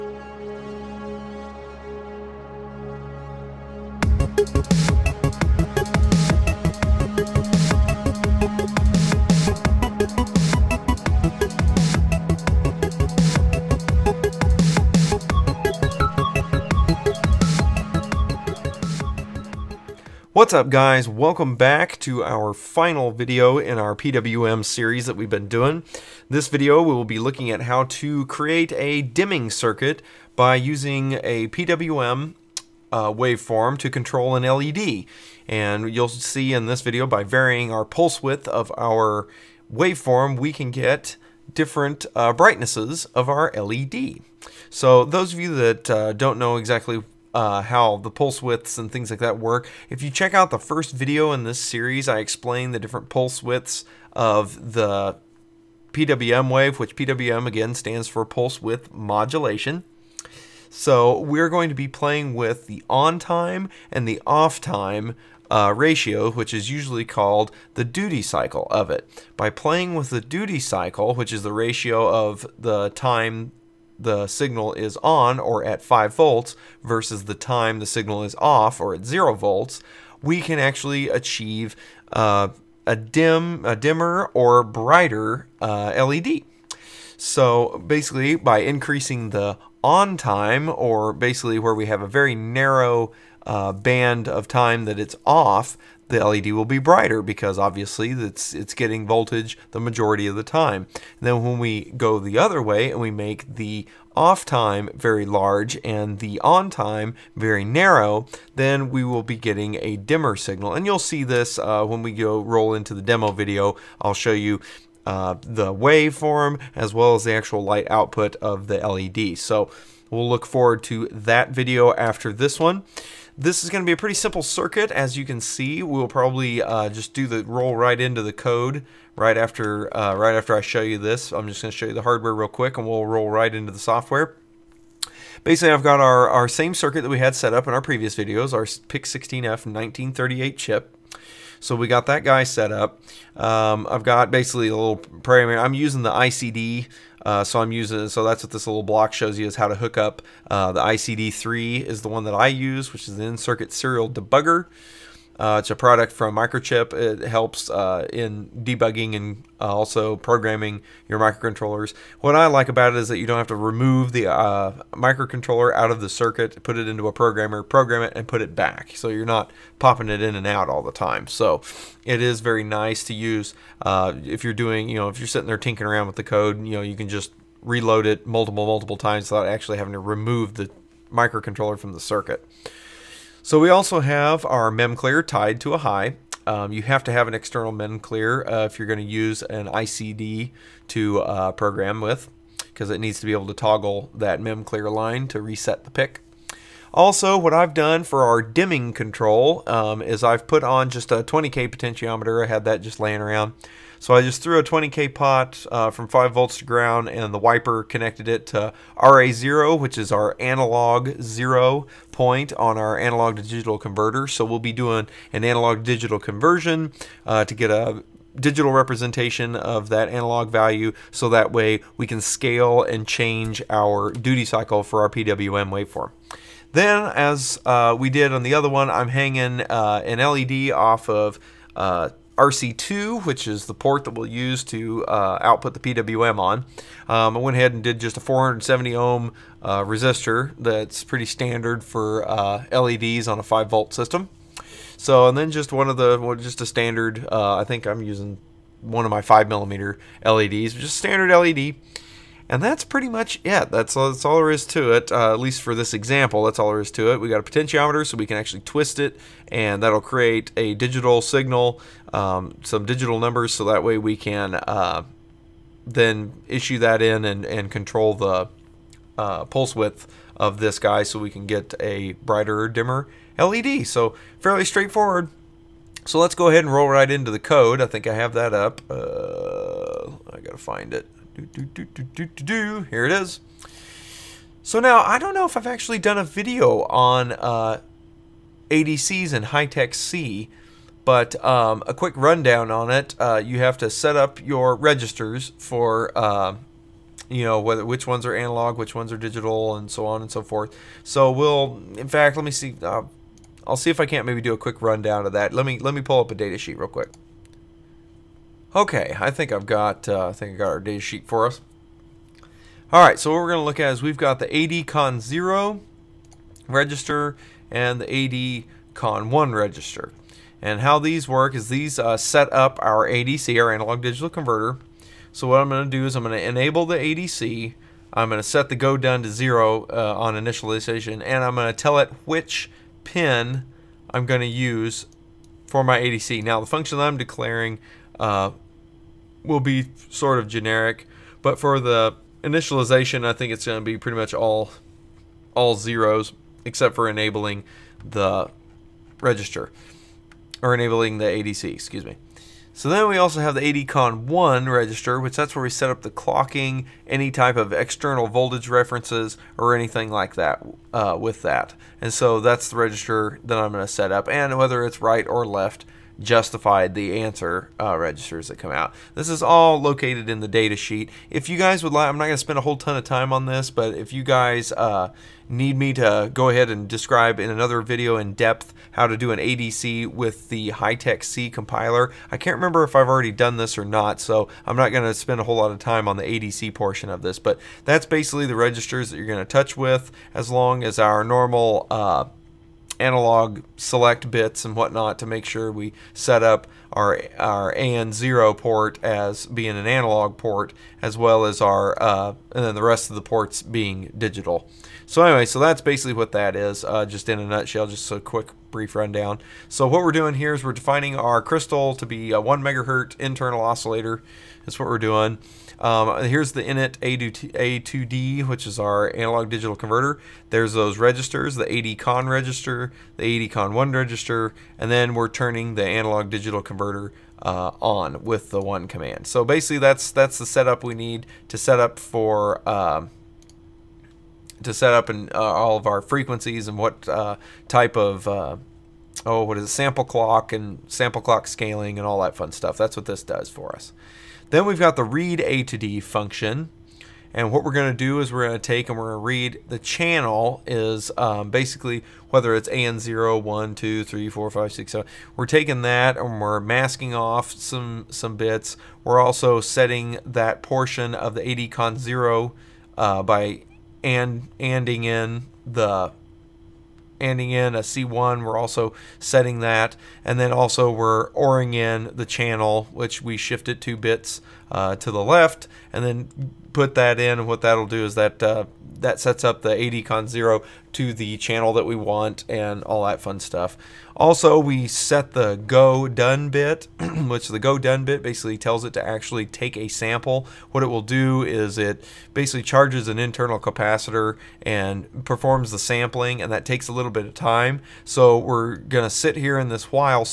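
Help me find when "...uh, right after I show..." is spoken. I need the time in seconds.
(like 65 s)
129 s.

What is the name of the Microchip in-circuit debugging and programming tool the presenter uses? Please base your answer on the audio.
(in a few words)
ICD3.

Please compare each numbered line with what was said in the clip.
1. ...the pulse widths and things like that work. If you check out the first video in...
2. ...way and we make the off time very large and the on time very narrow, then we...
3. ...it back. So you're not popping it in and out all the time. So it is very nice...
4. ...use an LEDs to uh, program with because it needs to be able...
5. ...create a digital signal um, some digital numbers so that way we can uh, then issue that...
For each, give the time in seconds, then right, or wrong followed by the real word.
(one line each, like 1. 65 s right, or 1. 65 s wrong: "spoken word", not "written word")
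1. 47 s right
2. 102 s right
3. 168 s right
4. 189 s wrong: "ICD", not "LEDs"
5. 259 s right.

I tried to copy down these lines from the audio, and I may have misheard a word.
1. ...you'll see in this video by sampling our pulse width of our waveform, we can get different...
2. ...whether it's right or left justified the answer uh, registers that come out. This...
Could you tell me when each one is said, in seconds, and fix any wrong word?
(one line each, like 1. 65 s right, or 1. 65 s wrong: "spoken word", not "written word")
1. 35 s wrong: "varying", not "sampling"
2. 364 s right.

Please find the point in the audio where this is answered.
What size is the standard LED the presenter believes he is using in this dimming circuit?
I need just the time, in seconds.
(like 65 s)
249 s.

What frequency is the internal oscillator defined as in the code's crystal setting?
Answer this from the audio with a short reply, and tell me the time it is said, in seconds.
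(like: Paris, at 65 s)
1 megahertz, at 412 s.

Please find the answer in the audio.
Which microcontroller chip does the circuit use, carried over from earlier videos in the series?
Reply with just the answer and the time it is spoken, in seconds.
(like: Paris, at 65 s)
PIC16F1938, at 138 s.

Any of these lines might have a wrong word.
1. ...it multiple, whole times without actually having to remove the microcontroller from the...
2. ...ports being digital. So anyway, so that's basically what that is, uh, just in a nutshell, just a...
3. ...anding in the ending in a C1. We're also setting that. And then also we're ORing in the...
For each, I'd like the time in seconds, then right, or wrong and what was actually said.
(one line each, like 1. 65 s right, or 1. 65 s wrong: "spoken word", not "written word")
1. 178 s wrong: "multiple", not "whole"
2. 403 s right
3. 464 s right.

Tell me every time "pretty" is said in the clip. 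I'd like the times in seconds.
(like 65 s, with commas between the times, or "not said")
123 s, 241 s, 252 s, 343 s.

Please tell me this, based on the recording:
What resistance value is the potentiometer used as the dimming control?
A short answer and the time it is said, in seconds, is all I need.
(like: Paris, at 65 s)
20K, at 201 s.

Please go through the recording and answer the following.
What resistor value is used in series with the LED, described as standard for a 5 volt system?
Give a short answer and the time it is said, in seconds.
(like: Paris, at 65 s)
470 ohm, at 238 s.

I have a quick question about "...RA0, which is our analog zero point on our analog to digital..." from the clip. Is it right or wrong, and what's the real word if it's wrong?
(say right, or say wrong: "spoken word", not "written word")
right.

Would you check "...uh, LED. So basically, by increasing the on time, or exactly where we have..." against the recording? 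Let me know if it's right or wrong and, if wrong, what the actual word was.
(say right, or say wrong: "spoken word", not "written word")
wrong: "basically", not "exactly".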